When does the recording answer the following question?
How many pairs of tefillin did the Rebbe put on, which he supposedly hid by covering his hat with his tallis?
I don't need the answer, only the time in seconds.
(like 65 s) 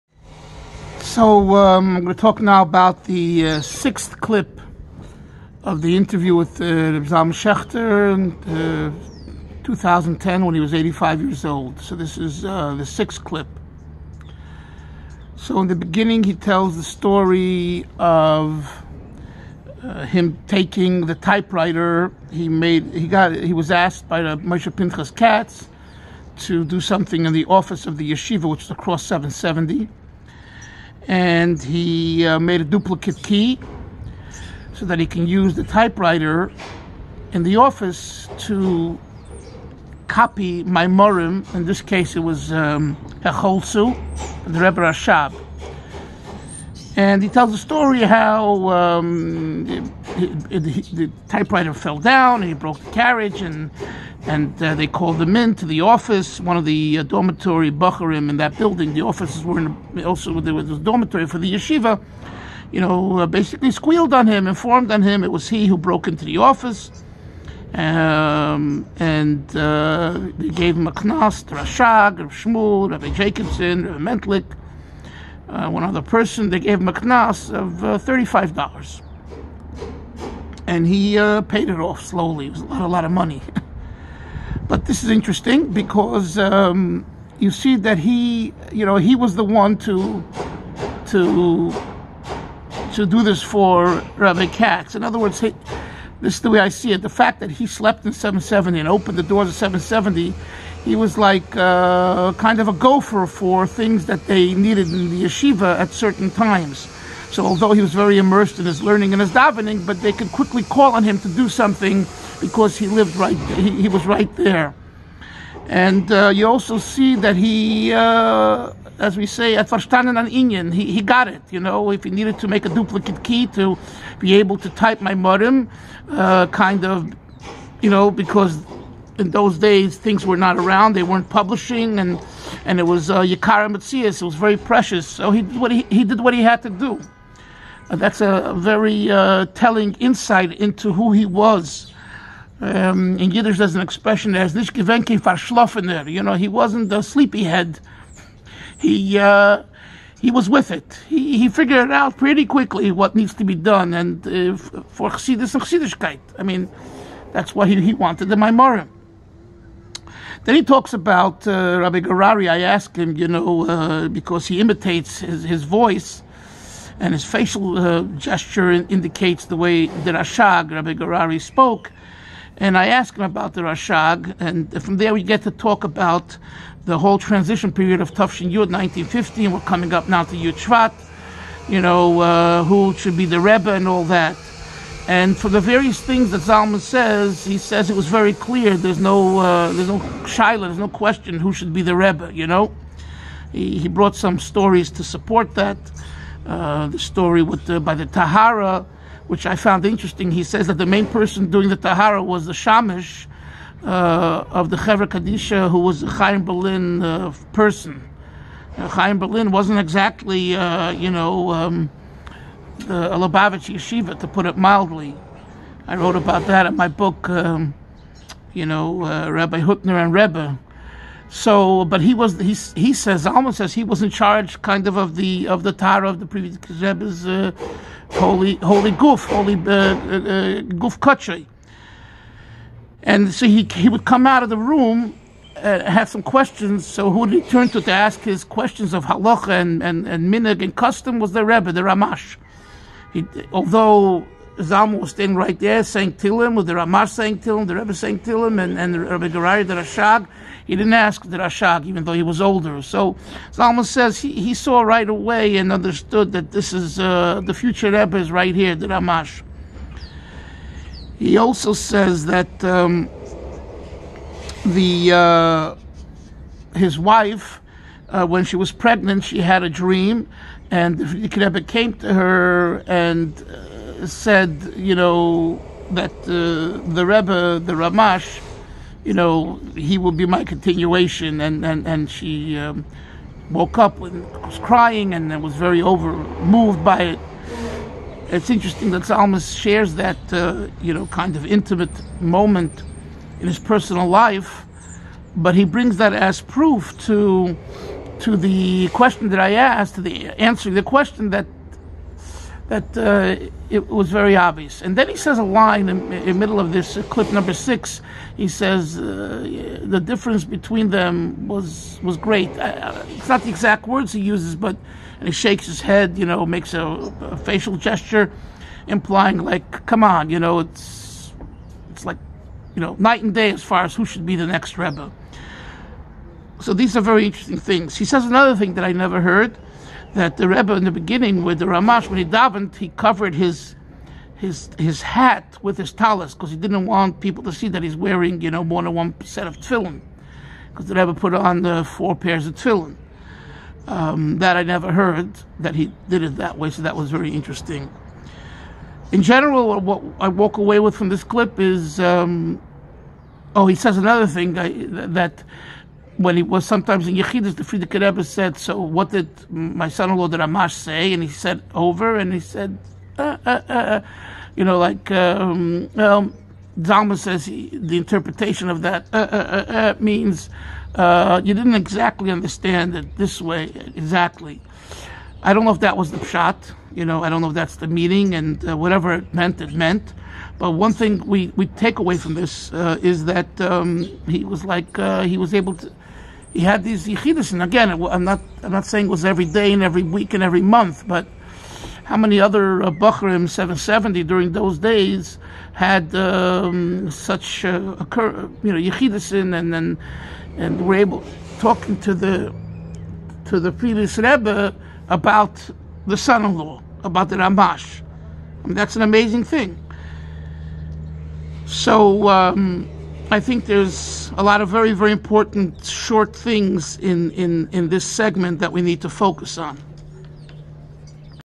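341 s.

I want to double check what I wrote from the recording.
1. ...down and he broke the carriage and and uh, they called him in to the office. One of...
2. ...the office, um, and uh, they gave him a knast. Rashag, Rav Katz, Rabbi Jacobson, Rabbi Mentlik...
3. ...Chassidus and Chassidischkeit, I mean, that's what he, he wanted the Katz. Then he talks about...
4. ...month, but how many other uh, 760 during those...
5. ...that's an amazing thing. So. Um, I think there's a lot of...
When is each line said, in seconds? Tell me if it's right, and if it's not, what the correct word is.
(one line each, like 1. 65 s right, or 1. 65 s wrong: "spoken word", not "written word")
1. 51 s right
2. 66 s wrong: "Shmuel", not "Katz"
3. 155 s wrong: "Maimorim", not "Katz"
4. 390 s wrong: "770", not "760"
5. 408 s right.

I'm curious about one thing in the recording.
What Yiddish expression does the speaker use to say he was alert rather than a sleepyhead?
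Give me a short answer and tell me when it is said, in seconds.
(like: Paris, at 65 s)
nicht gewenke, at 144 s.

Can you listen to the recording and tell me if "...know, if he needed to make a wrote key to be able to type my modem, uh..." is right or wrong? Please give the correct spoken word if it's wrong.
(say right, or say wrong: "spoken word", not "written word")
wrong: "duplicate", not "wrote".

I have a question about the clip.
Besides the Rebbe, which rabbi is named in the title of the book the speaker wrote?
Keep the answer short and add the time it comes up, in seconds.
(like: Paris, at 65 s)
Rabbi Hutner, at 219 s.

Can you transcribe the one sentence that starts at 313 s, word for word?
it's not the exact words he uses, but and he shakes his head.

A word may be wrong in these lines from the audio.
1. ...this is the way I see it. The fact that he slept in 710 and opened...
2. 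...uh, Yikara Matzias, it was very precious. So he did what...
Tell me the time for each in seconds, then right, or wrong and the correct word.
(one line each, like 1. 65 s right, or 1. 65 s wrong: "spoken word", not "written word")
1. 96 s wrong: "770", not "710"
2. 133 s right.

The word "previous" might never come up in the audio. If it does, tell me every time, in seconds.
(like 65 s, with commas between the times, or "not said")
226 s, 403 s.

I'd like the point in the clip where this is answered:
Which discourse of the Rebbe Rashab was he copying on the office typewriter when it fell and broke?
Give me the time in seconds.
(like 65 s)
43 s.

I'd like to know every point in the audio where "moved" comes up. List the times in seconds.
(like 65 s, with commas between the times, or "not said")
286 s.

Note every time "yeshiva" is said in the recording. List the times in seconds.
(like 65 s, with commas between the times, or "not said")
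28 s, 61 s, 105 s, 213 s.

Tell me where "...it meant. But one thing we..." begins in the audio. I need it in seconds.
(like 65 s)
379 s.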